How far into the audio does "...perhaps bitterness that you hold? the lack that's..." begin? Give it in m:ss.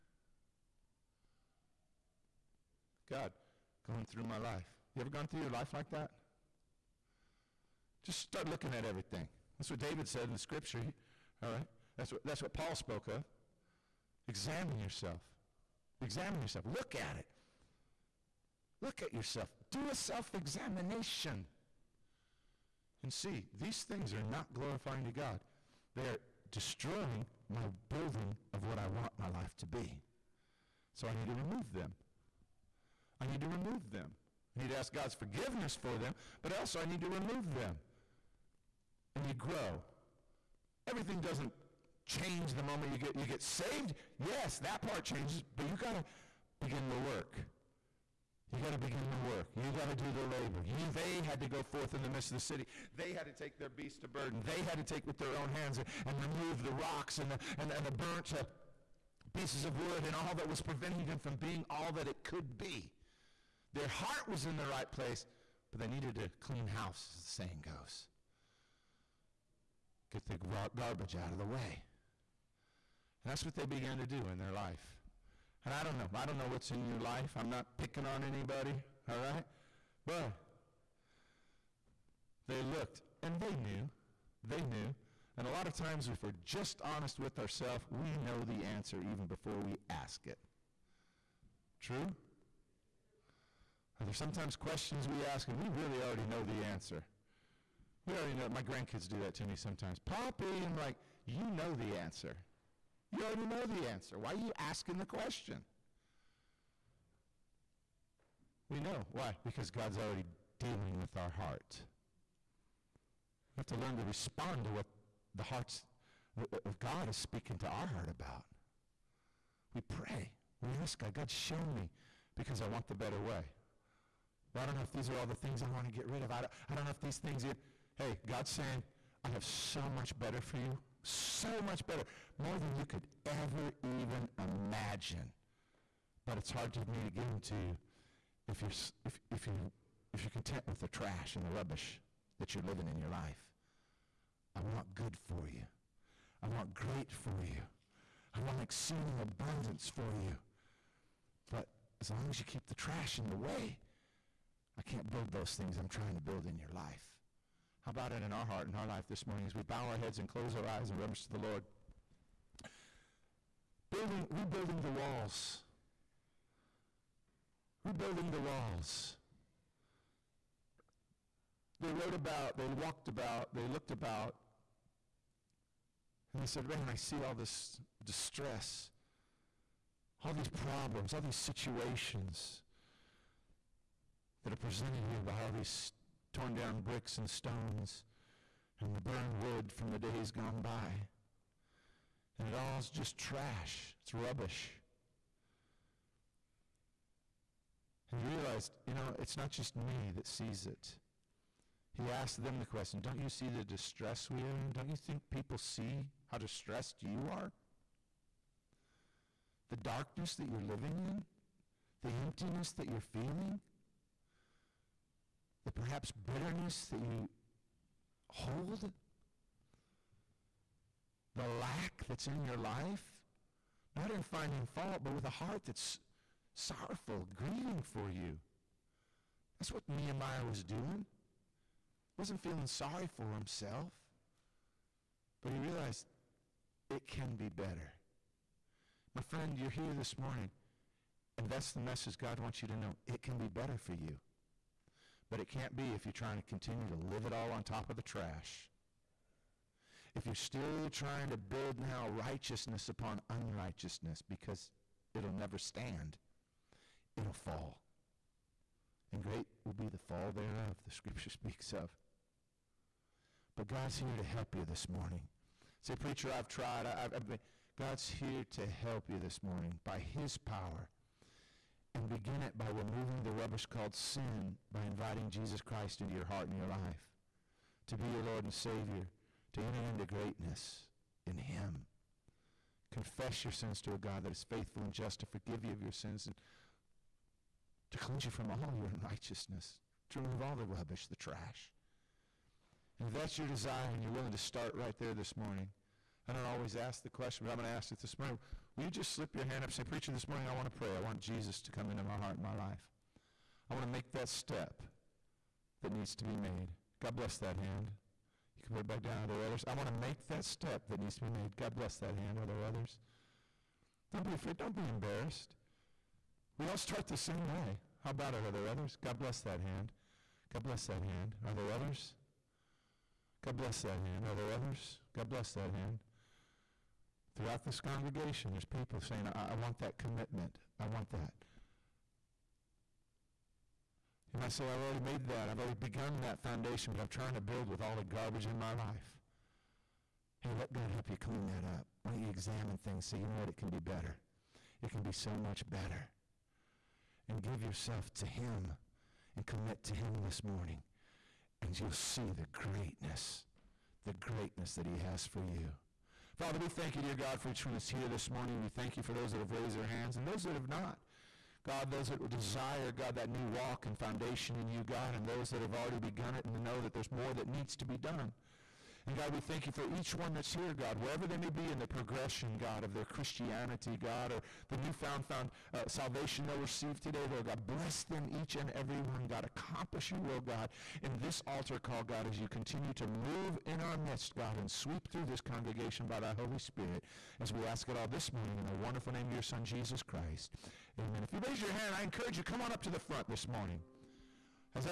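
3:35.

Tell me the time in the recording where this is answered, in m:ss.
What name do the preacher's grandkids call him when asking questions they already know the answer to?
1:40.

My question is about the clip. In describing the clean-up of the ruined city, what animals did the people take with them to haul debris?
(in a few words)
beast of burden.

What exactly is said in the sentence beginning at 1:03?
Their heart was in the right place, but they needed a clean house, as the saying goes.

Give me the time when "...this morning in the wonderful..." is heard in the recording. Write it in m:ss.
6:28.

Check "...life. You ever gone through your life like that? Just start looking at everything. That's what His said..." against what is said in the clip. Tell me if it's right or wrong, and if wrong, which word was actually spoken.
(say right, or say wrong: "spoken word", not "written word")
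wrong: "David", not "His".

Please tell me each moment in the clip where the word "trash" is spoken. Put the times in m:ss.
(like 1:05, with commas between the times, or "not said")
2:20, 2:32, 3:13, 4:08, 4:51.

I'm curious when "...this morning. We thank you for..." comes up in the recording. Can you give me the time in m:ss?
5:58.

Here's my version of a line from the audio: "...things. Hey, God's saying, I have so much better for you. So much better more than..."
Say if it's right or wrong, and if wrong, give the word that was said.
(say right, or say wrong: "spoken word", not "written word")
right.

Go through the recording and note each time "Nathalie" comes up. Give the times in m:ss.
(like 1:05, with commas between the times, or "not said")
not said.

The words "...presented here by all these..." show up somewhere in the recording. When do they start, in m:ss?
3:04.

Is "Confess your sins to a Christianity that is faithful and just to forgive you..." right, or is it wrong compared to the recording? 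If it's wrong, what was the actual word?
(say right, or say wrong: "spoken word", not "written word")
wrong: "God", not "Christianity".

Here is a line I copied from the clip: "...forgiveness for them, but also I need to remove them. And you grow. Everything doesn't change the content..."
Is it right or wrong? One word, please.
wrong.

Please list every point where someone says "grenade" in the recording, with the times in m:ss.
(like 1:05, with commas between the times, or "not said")
not said.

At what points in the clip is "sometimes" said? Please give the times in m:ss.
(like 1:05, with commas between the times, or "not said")
1:34, 1:39.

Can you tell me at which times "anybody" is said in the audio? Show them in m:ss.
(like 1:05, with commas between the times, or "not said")
1:18.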